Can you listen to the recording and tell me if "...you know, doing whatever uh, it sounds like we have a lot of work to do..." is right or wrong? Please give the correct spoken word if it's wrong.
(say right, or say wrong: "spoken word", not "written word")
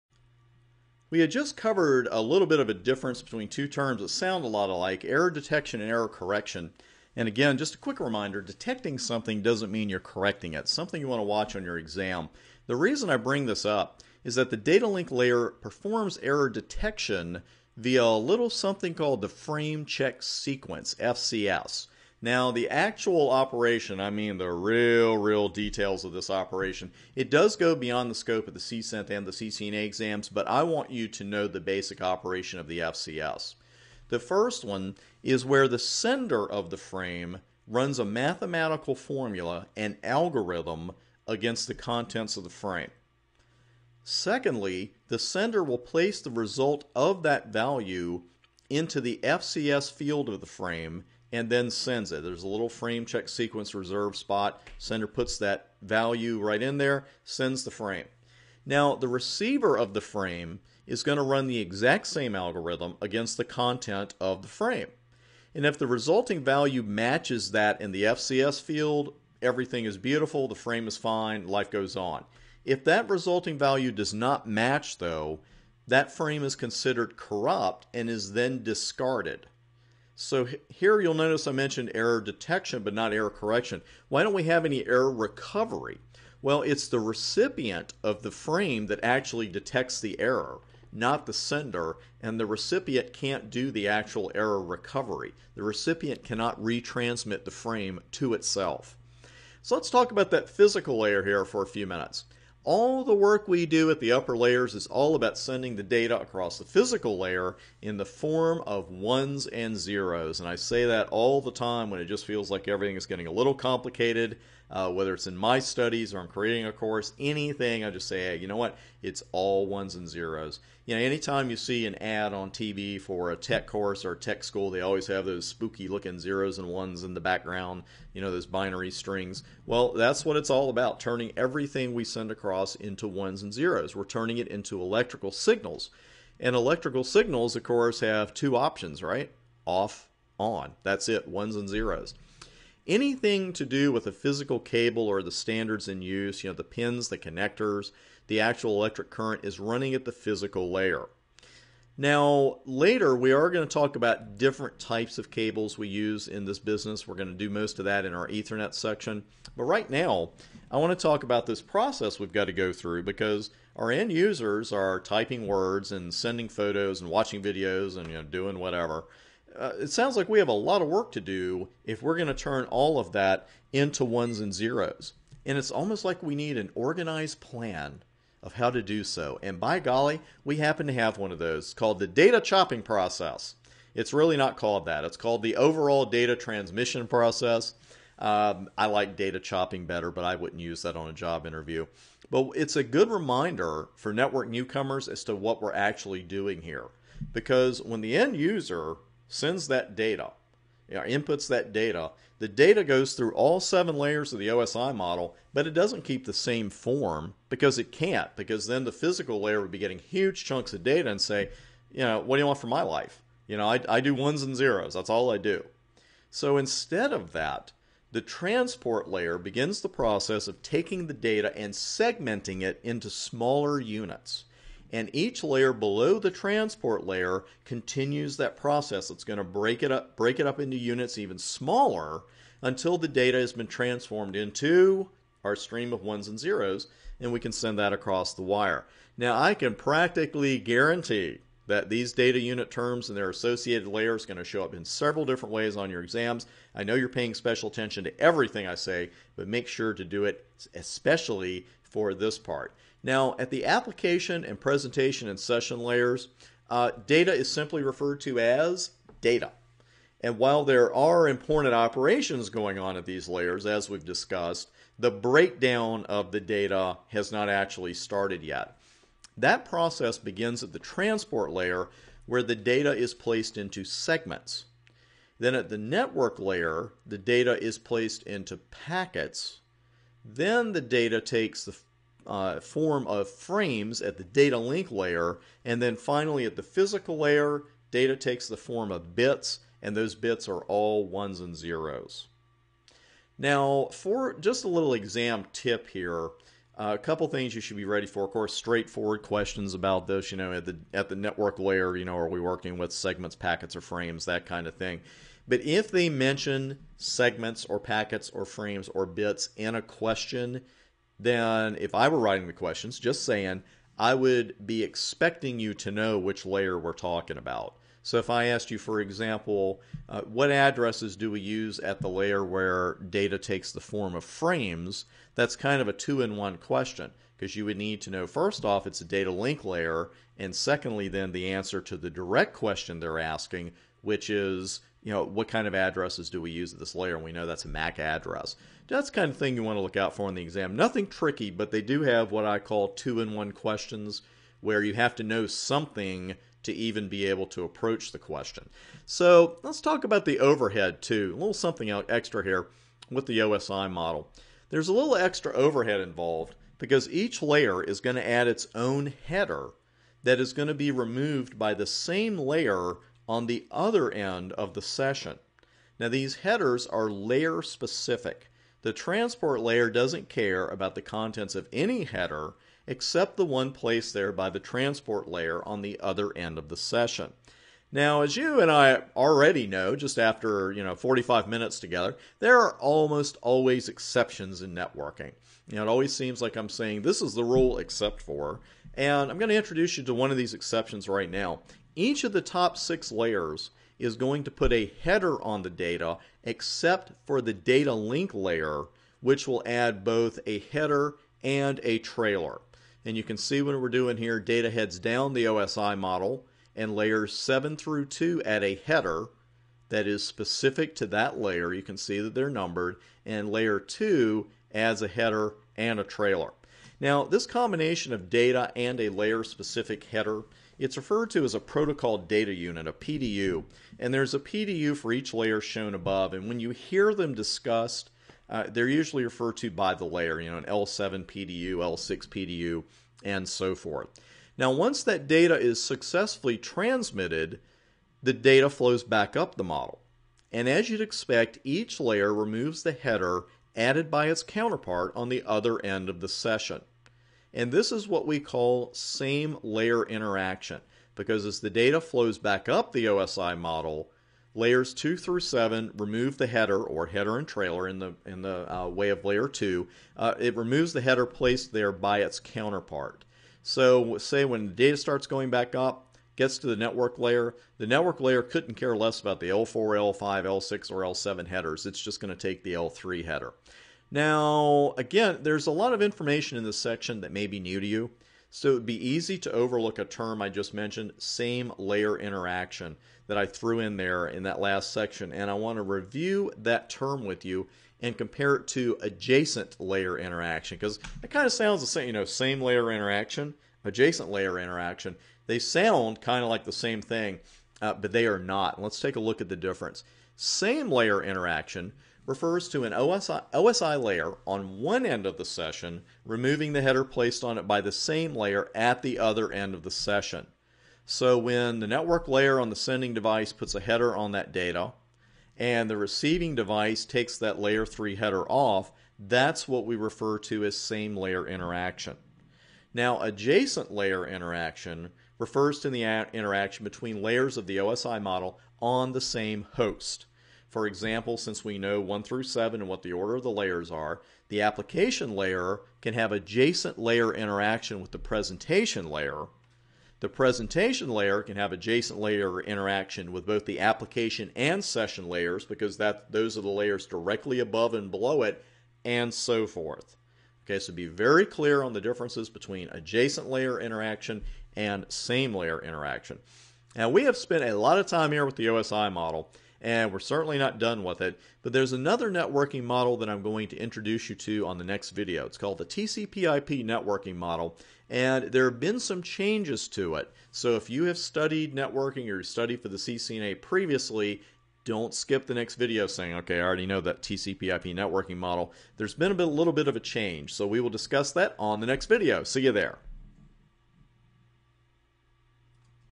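right.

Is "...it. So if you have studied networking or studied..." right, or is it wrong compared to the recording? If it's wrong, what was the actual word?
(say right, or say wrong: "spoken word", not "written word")
right.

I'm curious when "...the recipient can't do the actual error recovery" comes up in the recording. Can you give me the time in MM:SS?
01:32.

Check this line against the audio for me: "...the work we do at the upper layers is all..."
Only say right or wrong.
right.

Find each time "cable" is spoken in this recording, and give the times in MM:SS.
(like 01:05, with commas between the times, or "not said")
02:24, 02:35.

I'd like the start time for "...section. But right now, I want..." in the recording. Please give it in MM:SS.
02:38.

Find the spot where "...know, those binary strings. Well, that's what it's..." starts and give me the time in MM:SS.
02:08.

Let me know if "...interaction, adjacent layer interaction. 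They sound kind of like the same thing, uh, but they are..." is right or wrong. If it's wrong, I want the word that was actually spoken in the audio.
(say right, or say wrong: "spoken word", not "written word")
right.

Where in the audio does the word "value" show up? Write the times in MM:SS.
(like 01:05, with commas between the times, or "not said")
00:47, 00:55, 01:06, 01:13.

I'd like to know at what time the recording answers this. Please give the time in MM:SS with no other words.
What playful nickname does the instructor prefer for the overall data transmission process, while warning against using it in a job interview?
03:01.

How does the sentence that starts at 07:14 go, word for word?
Now, once that data is successfully transmitted, the data flows back up the model.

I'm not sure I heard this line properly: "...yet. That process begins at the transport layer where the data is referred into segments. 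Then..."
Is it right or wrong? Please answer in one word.
wrong.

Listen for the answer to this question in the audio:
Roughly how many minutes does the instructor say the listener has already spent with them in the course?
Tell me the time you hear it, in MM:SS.
06:20.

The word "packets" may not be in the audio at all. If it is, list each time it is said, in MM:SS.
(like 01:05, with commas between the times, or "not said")
04:38, 05:03, 05:07.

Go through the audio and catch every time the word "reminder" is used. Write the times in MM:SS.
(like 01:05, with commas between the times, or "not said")
00:07, 03:13.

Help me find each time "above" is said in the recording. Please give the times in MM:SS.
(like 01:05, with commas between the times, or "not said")
07:05, 09:07.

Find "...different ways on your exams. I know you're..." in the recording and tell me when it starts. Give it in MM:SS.
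04:05.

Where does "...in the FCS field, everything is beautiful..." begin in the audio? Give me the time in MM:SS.
01:07.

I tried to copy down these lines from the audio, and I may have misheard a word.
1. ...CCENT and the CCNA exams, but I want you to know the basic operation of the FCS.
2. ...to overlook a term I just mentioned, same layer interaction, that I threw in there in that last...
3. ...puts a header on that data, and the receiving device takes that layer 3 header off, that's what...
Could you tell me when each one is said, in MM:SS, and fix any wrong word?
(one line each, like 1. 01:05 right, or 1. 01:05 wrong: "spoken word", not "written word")
1. 00:28 right
2. 07:59 right
3. 08:33 right.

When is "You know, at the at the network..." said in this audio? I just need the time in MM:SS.
05:00.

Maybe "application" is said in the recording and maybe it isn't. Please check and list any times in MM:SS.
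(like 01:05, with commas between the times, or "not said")
04:13, 08:54, 09:03.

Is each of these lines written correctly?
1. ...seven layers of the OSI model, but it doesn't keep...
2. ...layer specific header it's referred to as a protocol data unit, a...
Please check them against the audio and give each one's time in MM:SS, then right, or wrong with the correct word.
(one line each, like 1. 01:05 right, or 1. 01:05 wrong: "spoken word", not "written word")
1. 03:23 right
2. 06:59 right.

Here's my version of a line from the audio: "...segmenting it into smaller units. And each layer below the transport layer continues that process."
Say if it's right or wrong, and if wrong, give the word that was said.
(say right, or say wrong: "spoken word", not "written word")
right.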